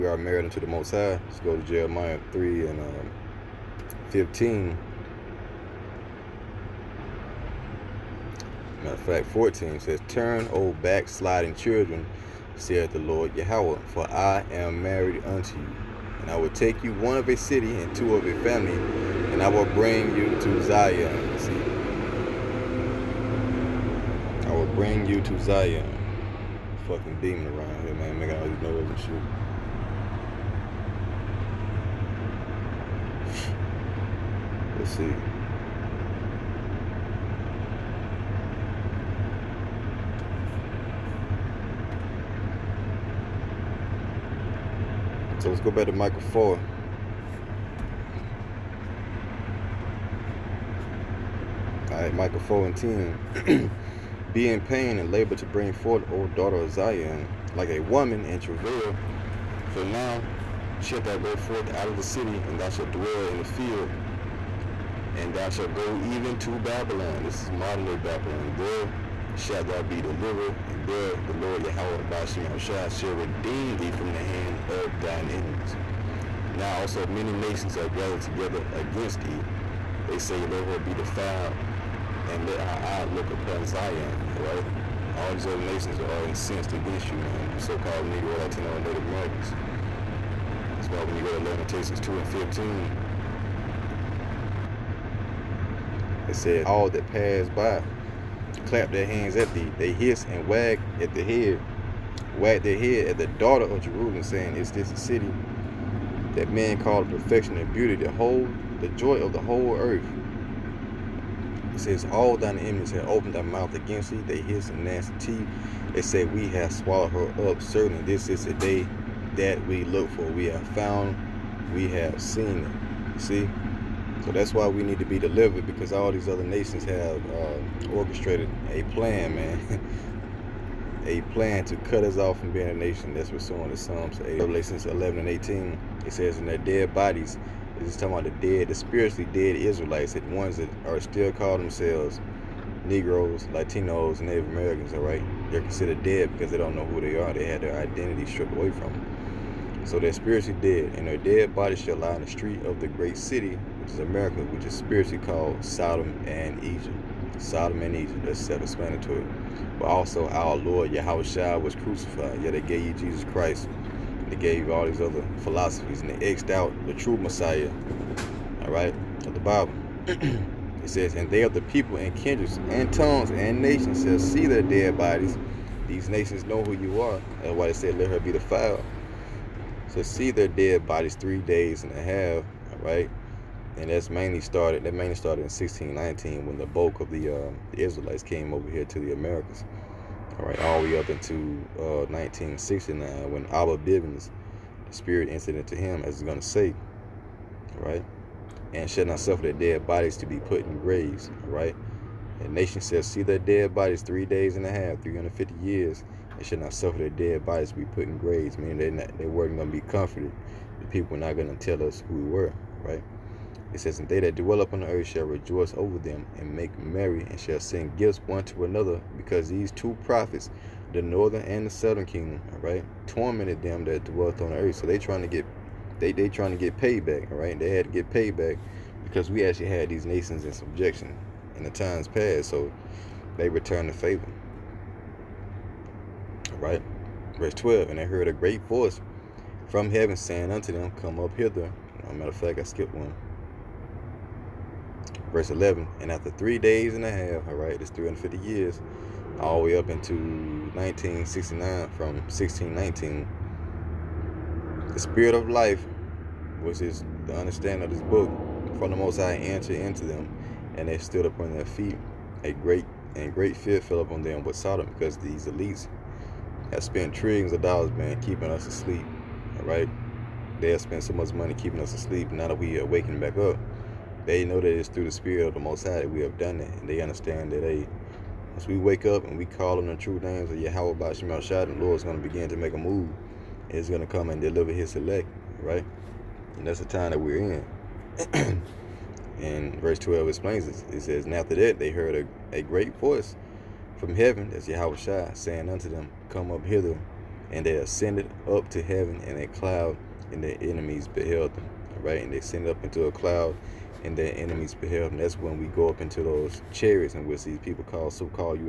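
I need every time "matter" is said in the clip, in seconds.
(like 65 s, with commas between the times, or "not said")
8 s, 242 s.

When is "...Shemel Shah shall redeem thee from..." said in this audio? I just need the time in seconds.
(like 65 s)
72 s.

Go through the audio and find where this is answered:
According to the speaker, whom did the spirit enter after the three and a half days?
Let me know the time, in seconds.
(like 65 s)
193 s.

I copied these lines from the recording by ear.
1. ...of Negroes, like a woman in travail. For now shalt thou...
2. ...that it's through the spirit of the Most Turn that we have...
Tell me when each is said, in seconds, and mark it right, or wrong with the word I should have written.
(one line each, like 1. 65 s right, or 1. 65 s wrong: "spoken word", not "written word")
1. 56 s wrong: "Zion", not "Negroes"
2. 274 s wrong: "High", not "Turn".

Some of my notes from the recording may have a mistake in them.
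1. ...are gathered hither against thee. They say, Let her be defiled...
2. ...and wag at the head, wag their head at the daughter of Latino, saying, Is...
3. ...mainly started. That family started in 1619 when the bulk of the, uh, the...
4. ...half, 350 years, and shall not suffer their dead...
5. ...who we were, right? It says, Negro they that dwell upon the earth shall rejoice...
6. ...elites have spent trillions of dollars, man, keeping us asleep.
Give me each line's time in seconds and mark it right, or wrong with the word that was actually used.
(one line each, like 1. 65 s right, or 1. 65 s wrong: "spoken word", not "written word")
1. 77 s wrong: "together", not "hither"
2. 100 s wrong: "Jerusalem", not "Latino"
3. 184 s wrong: "mainly", not "family"
4. 204 s right
5. 212 s wrong: "And", not "Negro"
6. 265 s right.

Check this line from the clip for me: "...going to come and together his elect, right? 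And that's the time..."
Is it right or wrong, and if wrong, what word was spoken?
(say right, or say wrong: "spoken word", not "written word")
wrong: "deliver", not "together".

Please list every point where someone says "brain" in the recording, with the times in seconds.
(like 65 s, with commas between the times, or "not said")
not said.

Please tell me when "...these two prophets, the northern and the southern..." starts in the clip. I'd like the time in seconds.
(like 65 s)
219 s.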